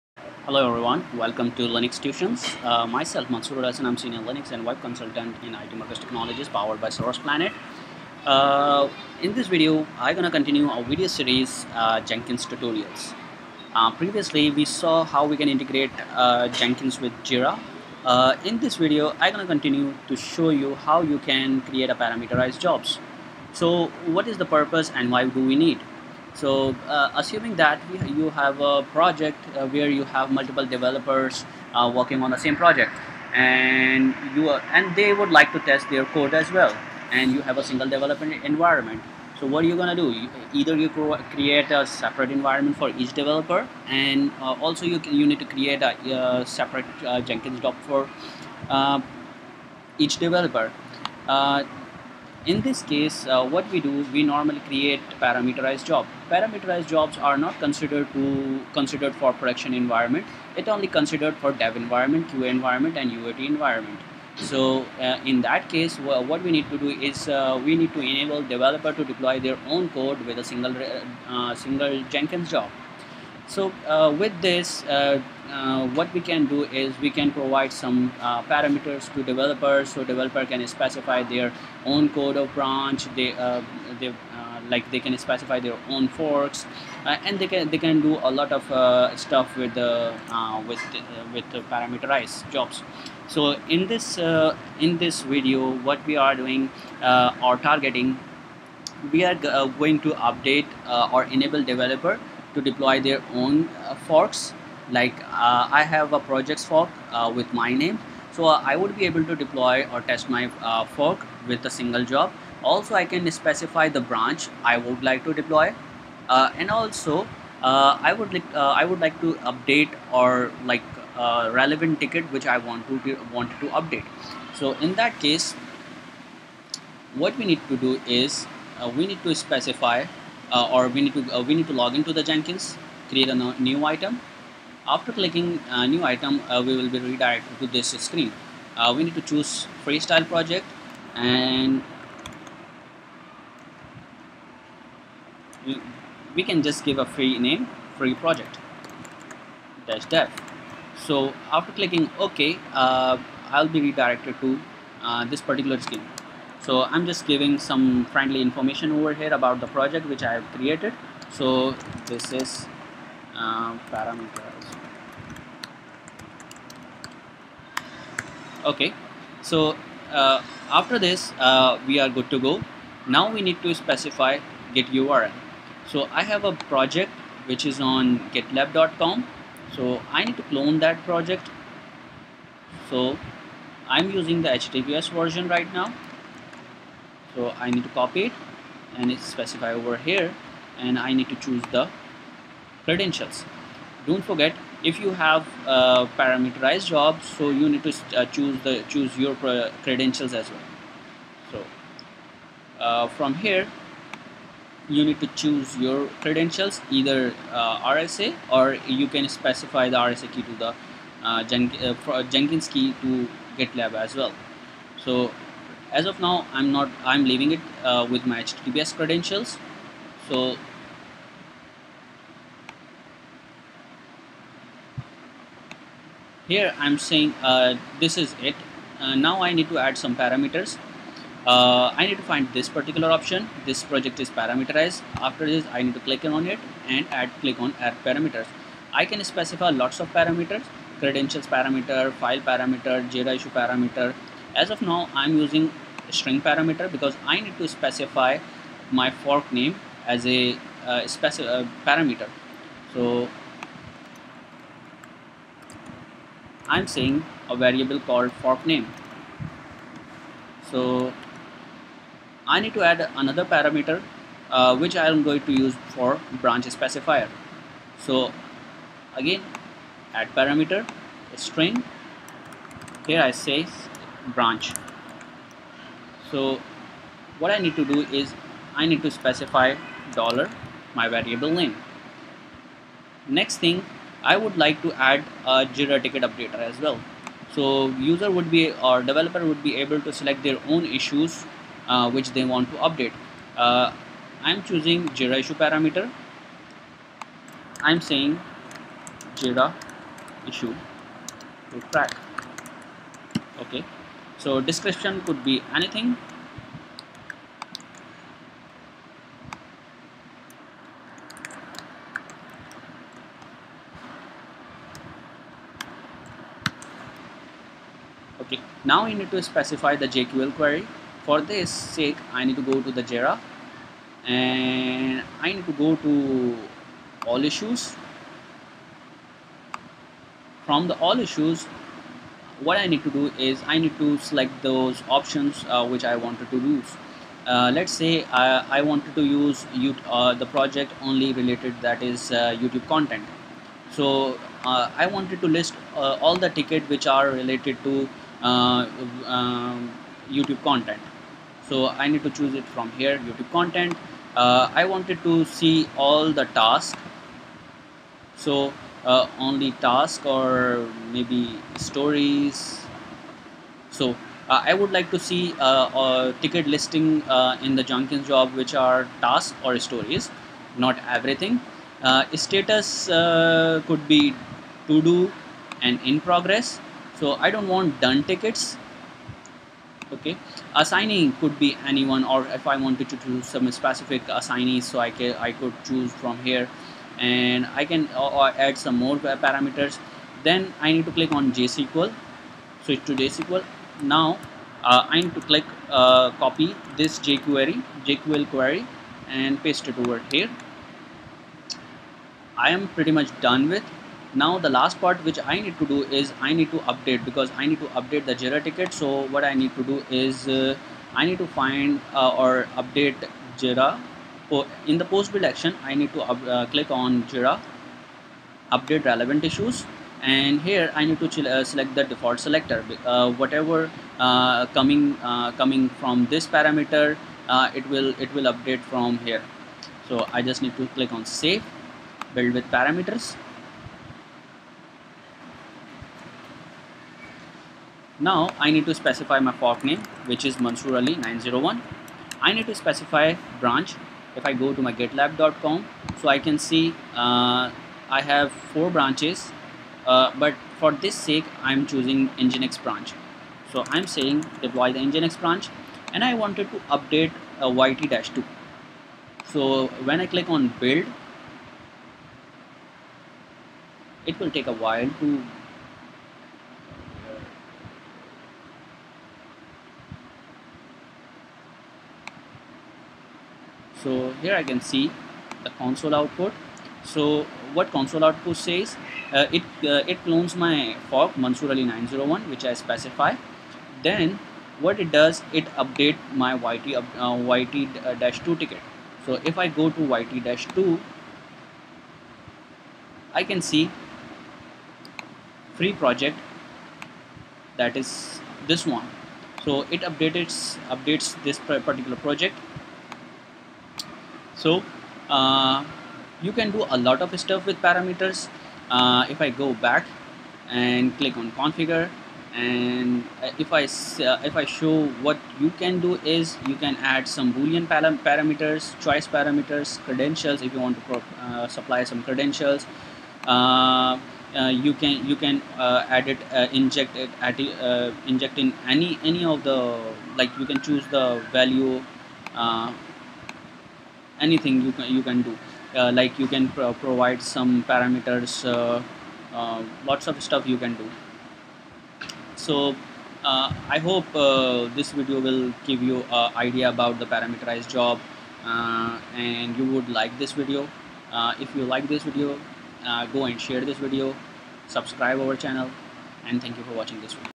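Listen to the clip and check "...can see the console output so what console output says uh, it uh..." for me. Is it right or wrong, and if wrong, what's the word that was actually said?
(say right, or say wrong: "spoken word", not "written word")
right.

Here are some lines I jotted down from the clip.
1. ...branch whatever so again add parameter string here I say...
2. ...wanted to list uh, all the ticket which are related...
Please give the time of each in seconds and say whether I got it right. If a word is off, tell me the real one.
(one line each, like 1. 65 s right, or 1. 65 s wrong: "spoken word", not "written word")
1. 266 s wrong: "specifier", not "whatever"
2. 345 s right.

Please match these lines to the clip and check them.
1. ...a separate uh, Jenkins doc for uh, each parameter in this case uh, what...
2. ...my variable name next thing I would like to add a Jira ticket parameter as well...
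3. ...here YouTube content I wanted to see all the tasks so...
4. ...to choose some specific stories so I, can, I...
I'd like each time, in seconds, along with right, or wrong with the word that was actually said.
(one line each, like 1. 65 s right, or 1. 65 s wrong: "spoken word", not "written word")
1. 46 s wrong: "developer", not "parameter"
2. 280 s wrong: "updater", not "parameter"
3. 352 s right
4. 383 s wrong: "assignees", not "stories".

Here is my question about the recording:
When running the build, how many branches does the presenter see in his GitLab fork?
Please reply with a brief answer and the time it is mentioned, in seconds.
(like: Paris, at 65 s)
4, at 448 s.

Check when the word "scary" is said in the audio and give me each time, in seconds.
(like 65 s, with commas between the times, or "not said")
not said.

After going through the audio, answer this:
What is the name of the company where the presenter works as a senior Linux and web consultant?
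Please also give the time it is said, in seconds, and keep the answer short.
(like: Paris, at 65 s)
IT Markets Technologies, at 5 s.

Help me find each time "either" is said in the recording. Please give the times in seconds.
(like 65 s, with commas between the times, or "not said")
40 s, 206 s.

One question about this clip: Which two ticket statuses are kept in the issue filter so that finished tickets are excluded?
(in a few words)
To do and in progress.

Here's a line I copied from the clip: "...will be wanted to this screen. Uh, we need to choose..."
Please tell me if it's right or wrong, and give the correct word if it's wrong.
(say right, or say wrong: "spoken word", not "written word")
wrong: "redirected", not "wanted".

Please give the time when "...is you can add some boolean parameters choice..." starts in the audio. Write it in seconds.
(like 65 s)
516 s.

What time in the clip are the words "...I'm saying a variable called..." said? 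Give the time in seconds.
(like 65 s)
256 s.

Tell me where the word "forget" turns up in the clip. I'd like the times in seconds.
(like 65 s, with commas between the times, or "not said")
194 s.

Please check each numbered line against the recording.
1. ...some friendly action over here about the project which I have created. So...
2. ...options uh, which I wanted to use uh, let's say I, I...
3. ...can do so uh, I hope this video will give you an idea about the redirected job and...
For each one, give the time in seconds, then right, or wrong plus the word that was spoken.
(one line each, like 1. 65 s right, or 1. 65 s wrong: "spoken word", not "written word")
1. 157 s wrong: "information", not "action"
2. 335 s right
3. 540 s wrong: "parameterized", not "redirected".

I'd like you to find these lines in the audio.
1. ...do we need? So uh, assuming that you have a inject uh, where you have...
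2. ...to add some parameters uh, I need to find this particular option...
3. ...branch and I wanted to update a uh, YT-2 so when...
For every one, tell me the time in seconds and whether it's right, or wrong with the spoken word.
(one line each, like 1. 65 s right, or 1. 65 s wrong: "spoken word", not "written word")
1. 25 s wrong: "project", not "inject"
2. 229 s right
3. 455 s right.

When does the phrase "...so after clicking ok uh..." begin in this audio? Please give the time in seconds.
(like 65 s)
151 s.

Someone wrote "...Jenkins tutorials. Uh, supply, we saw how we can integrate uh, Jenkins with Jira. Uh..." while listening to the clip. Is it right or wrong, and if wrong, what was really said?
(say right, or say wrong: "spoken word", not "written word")
wrong: "previously", not "supply".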